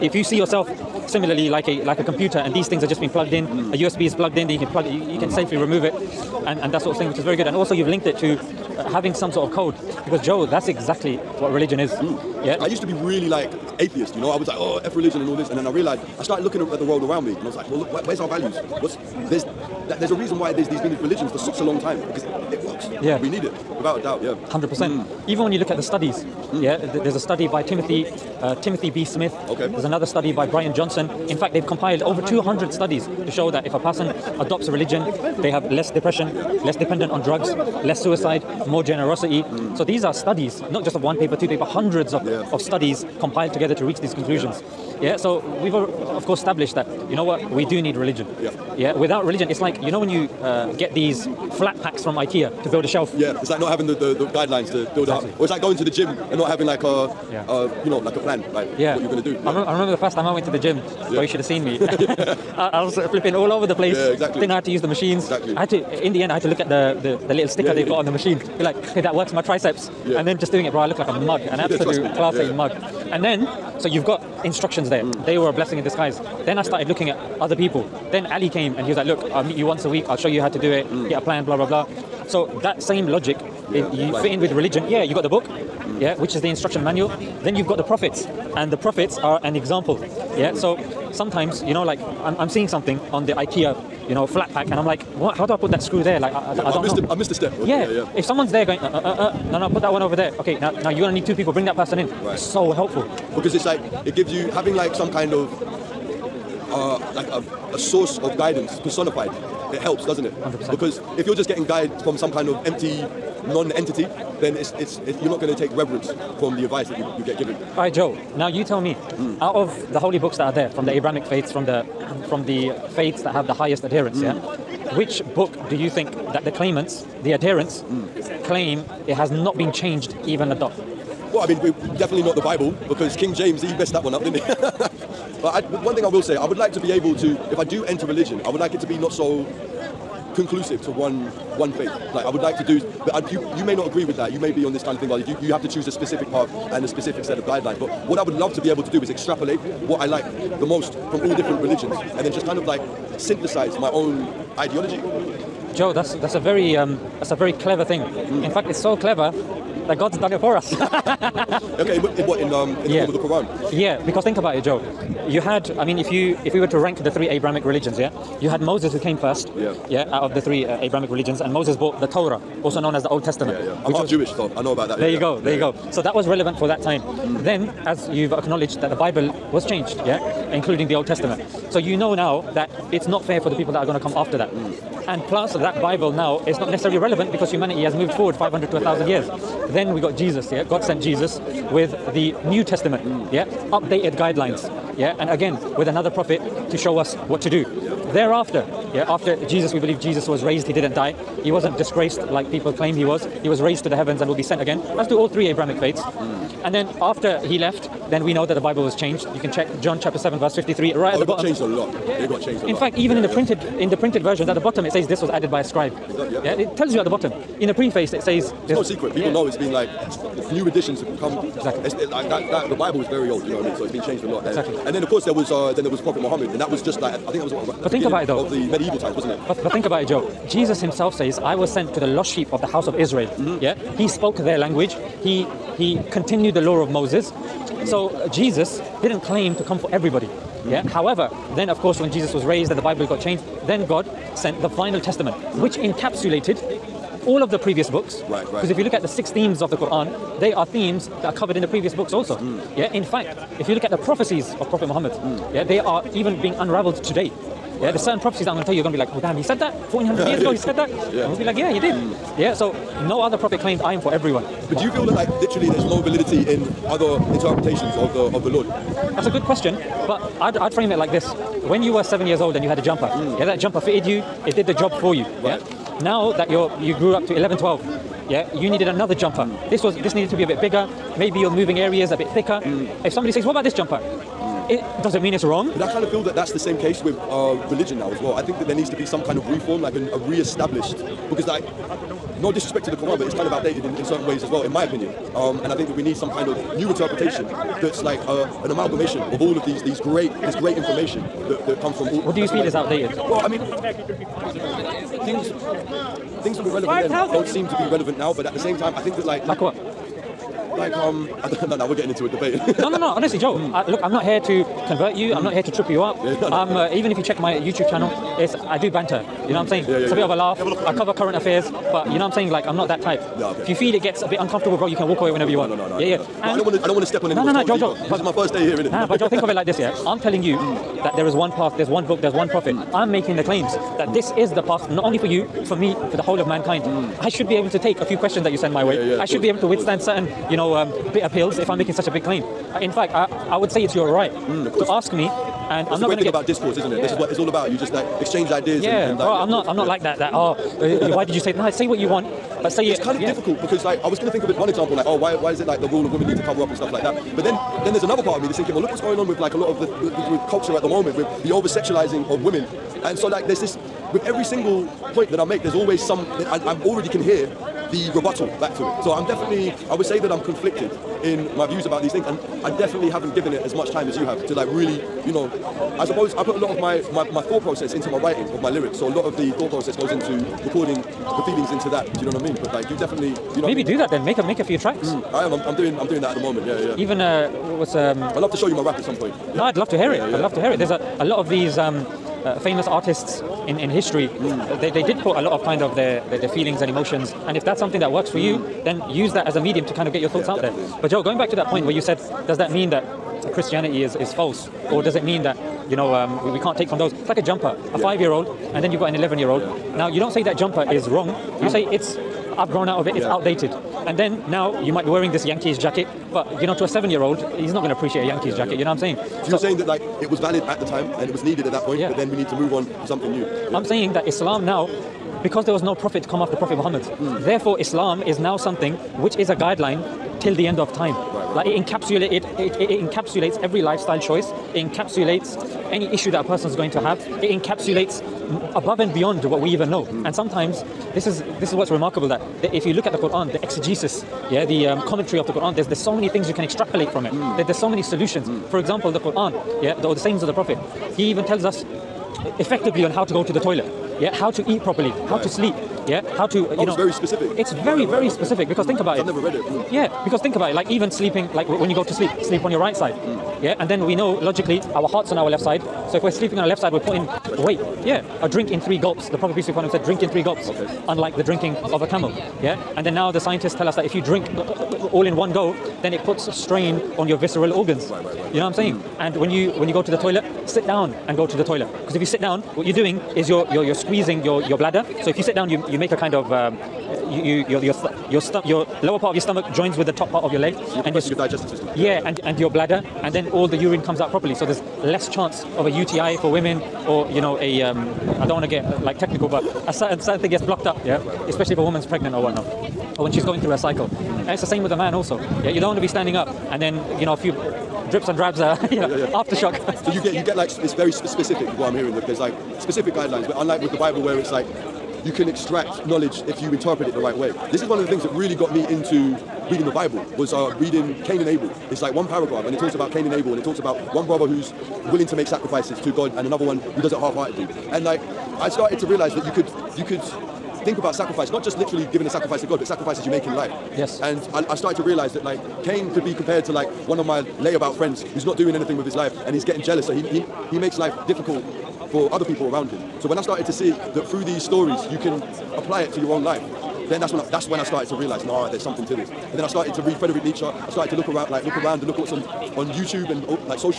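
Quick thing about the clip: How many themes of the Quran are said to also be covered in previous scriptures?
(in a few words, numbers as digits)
6.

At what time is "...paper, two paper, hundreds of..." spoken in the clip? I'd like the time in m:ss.
0:41.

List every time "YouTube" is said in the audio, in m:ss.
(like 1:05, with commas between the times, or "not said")
5:17, 9:12.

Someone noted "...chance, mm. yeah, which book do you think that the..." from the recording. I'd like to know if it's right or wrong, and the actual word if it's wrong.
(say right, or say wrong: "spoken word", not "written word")
wrong: "adherence", not "chance".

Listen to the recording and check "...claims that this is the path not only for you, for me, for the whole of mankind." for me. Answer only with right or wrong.
right.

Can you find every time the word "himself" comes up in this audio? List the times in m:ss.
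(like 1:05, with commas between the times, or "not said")
3:50.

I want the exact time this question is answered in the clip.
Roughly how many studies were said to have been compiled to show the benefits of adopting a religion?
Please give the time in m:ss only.
0:32.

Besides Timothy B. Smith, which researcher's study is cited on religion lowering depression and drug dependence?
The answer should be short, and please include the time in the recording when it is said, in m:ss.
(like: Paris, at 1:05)
Byron Johnson, at 0:30.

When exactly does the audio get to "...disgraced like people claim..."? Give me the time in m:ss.
3:21.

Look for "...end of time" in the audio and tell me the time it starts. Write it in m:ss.
7:10.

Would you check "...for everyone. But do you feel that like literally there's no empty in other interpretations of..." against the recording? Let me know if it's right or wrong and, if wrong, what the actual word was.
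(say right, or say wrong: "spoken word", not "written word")
wrong: "validity", not "empty".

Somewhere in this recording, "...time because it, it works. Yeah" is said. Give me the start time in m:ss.
0:21.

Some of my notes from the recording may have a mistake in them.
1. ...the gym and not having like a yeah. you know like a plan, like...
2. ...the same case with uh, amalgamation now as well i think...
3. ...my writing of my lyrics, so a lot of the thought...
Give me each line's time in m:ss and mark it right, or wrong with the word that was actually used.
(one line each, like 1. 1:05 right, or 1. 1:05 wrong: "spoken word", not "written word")
1. 0:55 right
2. 4:46 wrong: "religion", not "amalgamation"
3. 6:18 right.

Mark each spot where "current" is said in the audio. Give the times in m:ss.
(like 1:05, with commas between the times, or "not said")
5:21.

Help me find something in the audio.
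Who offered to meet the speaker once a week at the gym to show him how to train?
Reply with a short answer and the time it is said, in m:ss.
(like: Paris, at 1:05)
Ali, at 1:18.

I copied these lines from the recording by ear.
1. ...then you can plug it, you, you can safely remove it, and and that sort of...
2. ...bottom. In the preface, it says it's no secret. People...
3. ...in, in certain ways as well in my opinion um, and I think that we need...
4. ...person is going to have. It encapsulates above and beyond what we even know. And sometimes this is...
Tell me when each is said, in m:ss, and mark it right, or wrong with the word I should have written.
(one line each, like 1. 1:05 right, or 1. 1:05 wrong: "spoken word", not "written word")
1. 0:04 right
2. 3:37 right
3. 4:53 right
4. 7:16 right.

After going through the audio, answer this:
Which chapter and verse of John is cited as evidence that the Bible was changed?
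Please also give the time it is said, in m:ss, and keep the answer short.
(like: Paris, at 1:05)
John 7:53, at 3:29.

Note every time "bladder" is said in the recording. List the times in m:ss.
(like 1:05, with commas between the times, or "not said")
8:04, 8:12.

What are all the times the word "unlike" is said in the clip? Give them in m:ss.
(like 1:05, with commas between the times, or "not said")
7:51, 8:33.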